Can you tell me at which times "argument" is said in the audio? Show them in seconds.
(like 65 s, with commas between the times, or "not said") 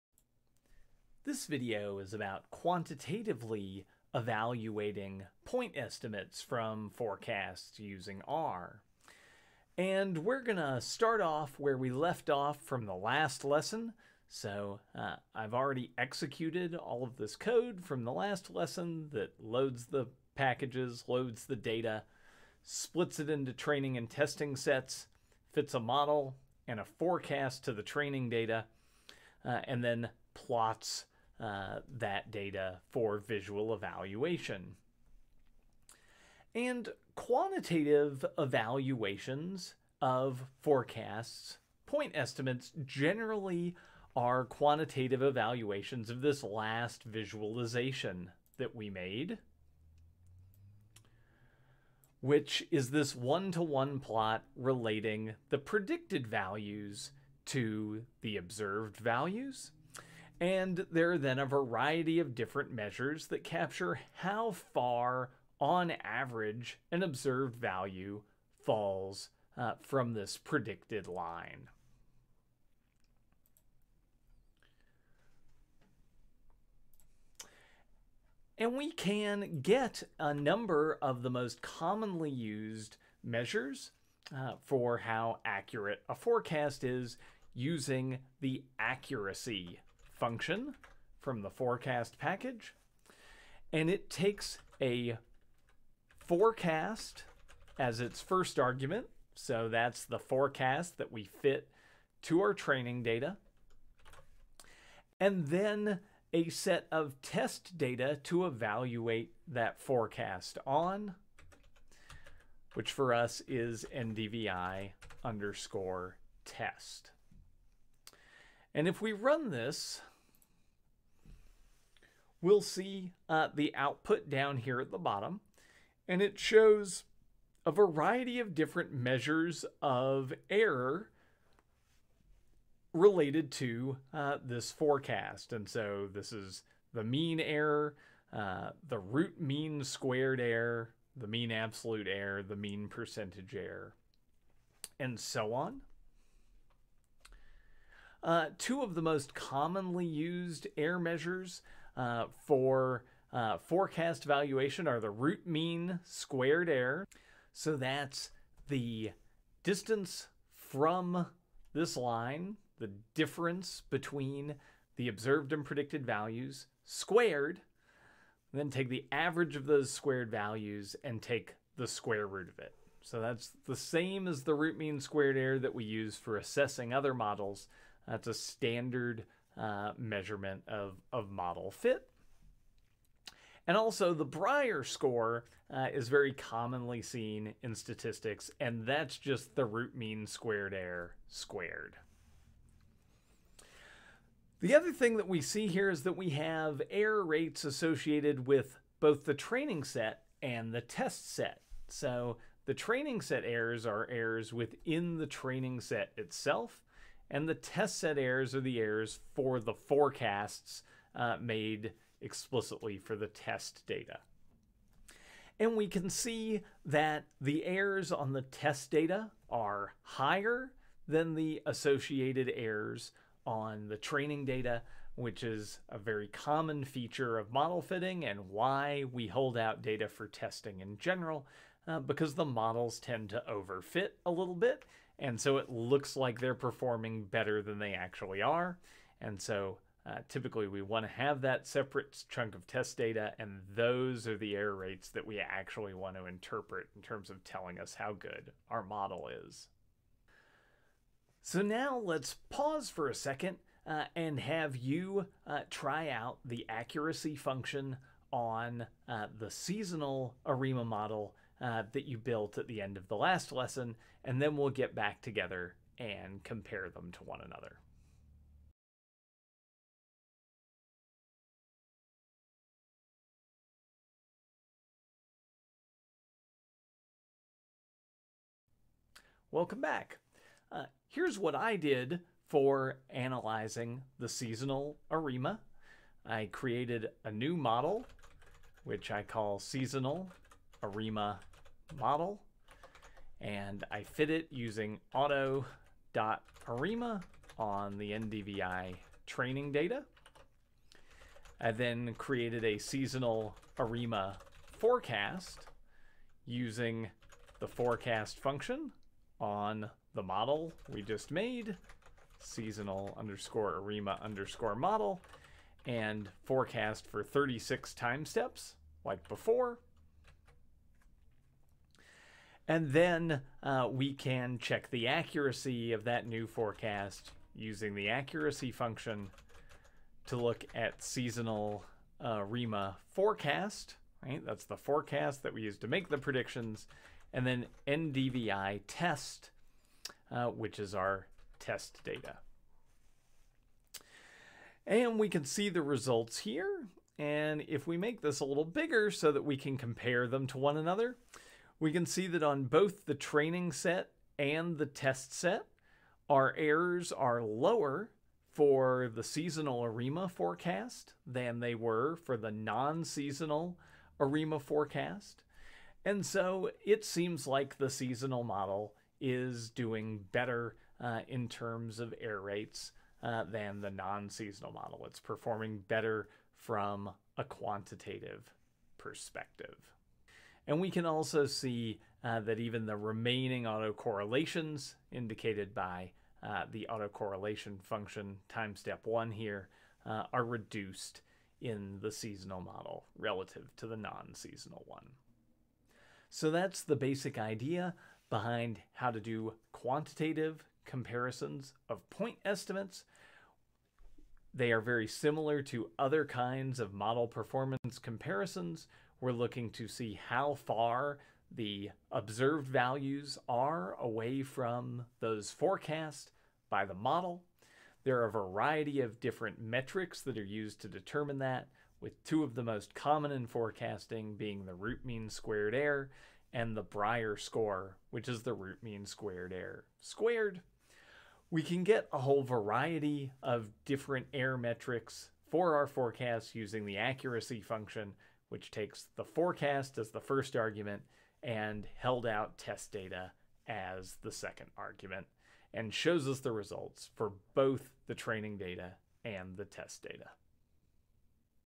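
98 s, 440 s, 444 s.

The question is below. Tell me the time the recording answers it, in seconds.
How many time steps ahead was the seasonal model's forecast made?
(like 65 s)
317 s.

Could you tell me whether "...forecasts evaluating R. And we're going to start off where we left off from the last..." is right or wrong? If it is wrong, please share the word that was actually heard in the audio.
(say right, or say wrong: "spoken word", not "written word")
wrong: "using", not "evaluating".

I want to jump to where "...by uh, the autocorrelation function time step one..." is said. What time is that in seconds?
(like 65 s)
385 s.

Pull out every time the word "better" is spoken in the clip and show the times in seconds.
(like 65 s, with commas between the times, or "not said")
237 s, 370 s, 375 s.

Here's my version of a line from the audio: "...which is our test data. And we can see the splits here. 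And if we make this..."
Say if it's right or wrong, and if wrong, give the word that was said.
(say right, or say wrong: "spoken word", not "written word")
wrong: "results", not "splits".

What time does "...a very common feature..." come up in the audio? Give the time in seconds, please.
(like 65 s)
225 s.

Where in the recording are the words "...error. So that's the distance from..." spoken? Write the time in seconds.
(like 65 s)
156 s.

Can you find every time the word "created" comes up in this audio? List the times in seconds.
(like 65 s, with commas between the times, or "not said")
286 s, 302 s.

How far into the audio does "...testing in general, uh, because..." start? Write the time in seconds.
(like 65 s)
230 s.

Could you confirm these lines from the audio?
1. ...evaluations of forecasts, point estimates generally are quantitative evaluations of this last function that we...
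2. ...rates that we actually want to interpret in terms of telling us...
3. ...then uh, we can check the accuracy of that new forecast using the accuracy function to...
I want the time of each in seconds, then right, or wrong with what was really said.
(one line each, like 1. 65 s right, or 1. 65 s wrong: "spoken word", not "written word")
1. 38 s wrong: "visualization", not "function"
2. 244 s right
3. 322 s right.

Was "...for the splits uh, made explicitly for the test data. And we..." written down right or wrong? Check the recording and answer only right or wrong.
wrong.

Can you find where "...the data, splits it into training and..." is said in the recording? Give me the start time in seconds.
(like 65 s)
21 s.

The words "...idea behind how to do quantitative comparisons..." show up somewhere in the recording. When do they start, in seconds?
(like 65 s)
397 s.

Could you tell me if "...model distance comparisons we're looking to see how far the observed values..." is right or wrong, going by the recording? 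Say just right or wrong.
wrong.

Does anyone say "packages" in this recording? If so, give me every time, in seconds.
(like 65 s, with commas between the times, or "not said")
20 s, 92 s.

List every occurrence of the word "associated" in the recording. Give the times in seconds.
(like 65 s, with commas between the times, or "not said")
197 s, 221 s.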